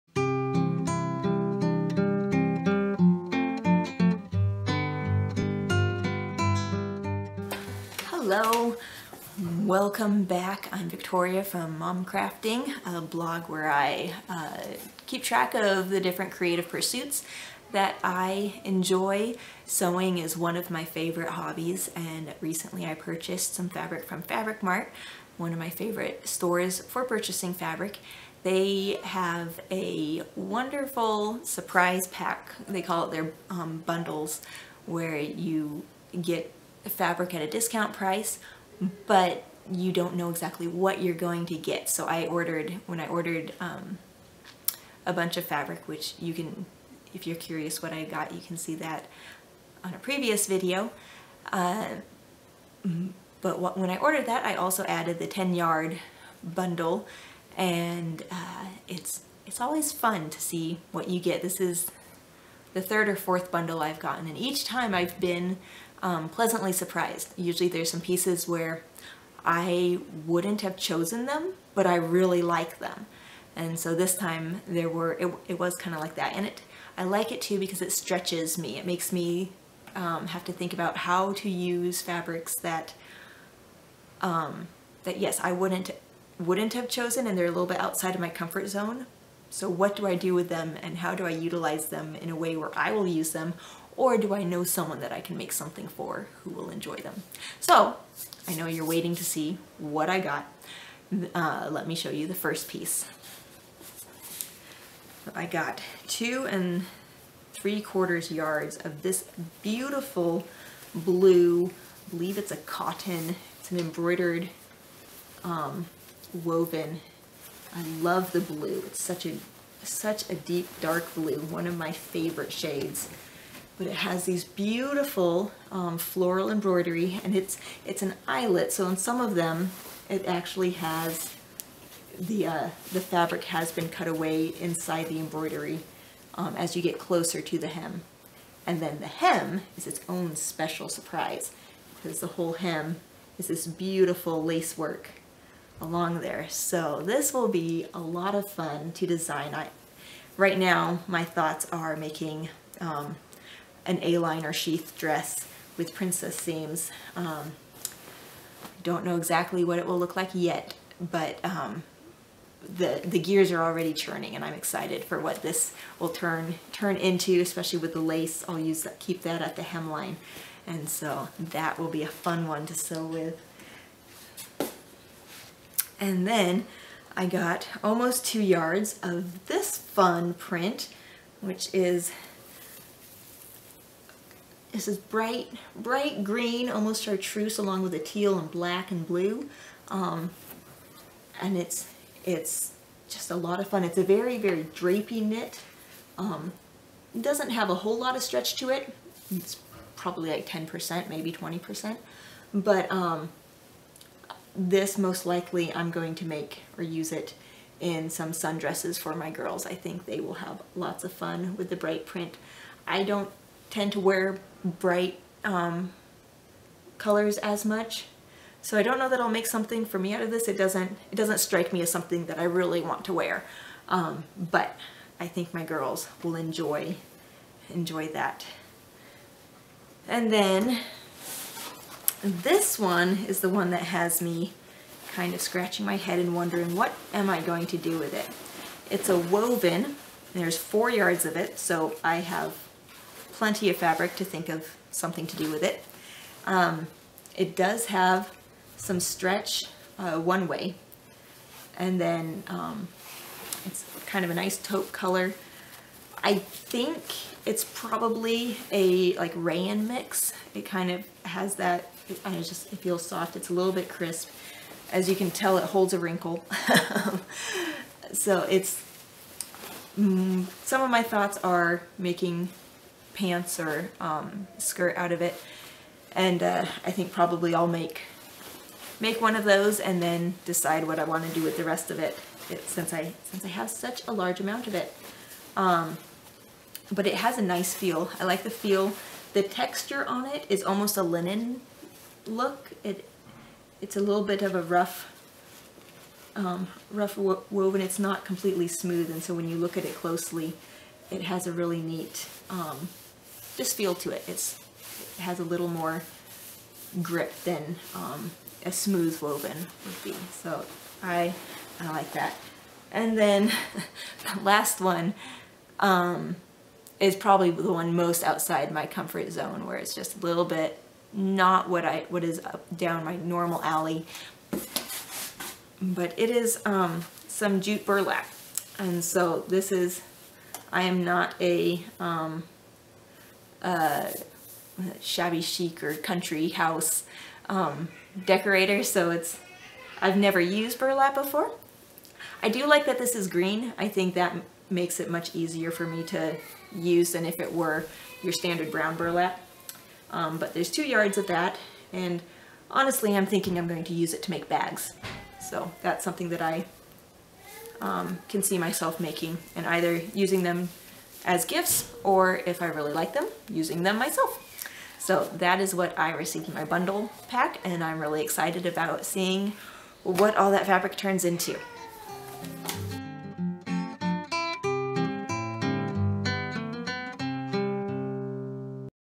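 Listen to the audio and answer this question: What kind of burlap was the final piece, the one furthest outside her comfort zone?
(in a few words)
jute burlap.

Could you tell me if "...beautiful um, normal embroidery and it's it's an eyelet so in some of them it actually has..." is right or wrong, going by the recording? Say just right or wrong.
wrong.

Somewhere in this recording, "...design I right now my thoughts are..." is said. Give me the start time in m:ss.
2:29.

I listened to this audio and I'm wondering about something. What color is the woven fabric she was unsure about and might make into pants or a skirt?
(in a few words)
taupe.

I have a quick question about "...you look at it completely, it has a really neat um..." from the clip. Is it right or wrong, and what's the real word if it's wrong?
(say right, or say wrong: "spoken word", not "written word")
wrong: "closely", not "completely".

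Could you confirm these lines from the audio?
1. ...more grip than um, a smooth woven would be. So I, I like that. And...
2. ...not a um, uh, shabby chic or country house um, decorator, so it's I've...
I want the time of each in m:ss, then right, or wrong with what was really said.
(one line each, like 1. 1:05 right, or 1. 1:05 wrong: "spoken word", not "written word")
1. 5:05 right
2. 5:31 right.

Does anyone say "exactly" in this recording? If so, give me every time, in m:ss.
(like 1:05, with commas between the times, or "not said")
0:40, 2:39.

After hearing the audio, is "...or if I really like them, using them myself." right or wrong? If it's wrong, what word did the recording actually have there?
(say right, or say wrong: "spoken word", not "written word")
right.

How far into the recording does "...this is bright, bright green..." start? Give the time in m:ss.
3:04.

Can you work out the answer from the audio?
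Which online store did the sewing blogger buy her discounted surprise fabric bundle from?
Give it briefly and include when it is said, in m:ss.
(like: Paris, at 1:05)
Fabric Mart, at 0:24.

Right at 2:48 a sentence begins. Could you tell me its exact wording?
I'll use that, keep that at the hemline.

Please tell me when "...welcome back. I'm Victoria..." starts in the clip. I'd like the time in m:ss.
0:09.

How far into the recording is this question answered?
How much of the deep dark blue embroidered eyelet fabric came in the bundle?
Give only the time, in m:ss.
1:46.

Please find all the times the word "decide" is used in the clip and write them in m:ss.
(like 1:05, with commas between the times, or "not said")
4:40.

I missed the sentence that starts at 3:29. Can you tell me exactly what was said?
I think they will have lots of fun with the bright print.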